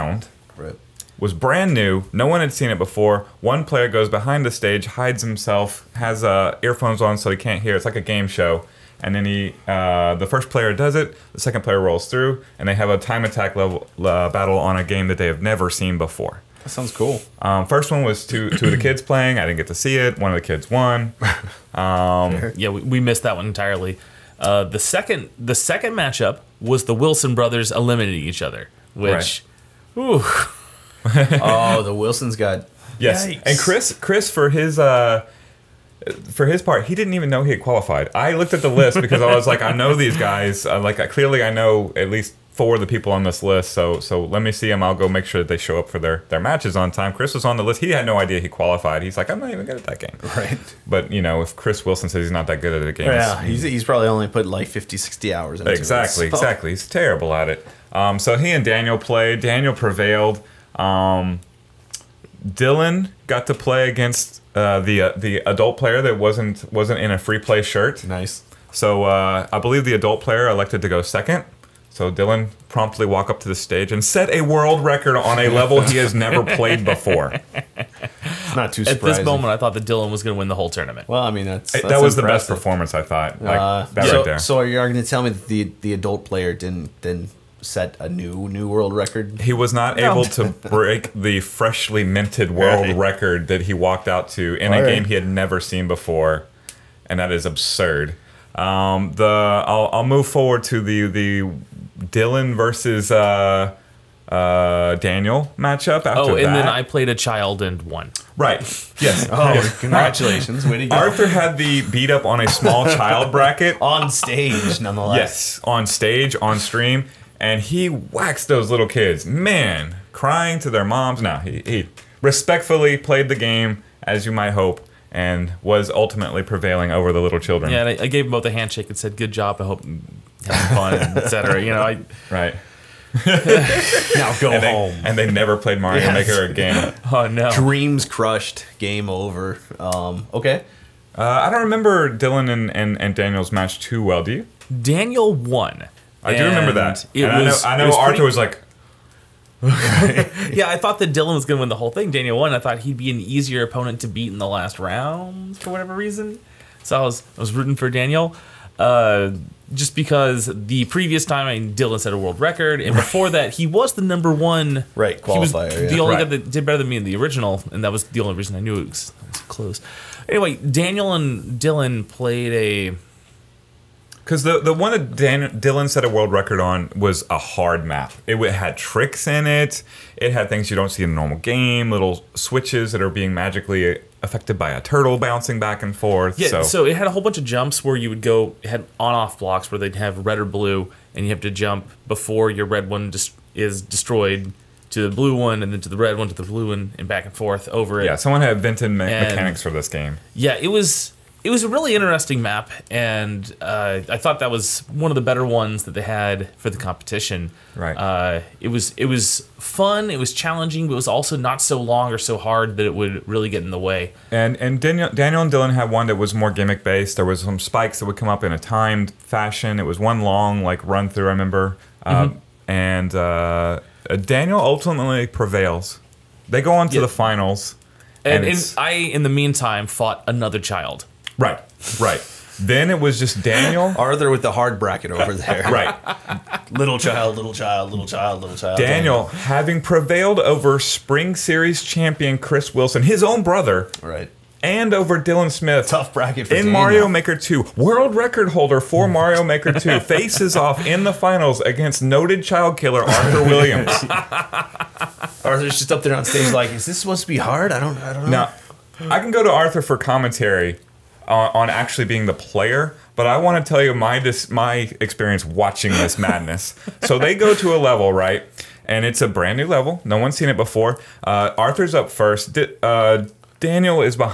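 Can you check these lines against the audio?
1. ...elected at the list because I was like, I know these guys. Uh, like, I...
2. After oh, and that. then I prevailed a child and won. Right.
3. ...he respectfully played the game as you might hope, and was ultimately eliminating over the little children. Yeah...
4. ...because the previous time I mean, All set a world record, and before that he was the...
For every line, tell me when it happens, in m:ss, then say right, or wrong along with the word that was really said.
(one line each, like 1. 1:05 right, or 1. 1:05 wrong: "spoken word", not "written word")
1. 0:38 wrong: "looked", not "elected"
2. 1:46 wrong: "played", not "prevailed"
3. 2:01 wrong: "prevailing", not "eliminating"
4. 2:39 wrong: "Dylan", not "All".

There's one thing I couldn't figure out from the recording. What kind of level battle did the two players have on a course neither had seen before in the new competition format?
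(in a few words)
time attack.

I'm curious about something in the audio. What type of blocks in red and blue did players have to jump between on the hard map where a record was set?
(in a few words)
on off blocks.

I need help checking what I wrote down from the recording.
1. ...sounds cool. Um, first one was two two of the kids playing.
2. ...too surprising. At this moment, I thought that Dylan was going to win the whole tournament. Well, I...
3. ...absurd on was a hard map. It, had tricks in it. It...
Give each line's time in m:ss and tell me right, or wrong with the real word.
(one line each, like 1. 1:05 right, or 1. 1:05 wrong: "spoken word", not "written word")
1. 0:16 right
2. 1:18 right
3. 2:56 wrong: "record", not "absurd".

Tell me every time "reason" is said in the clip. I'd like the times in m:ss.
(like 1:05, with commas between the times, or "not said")
2:35, 2:48.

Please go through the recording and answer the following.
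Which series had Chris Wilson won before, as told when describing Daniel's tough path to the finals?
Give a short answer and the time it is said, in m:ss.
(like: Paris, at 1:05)
Spring Series, at 4:00.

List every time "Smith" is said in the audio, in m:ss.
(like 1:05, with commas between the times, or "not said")
4:05.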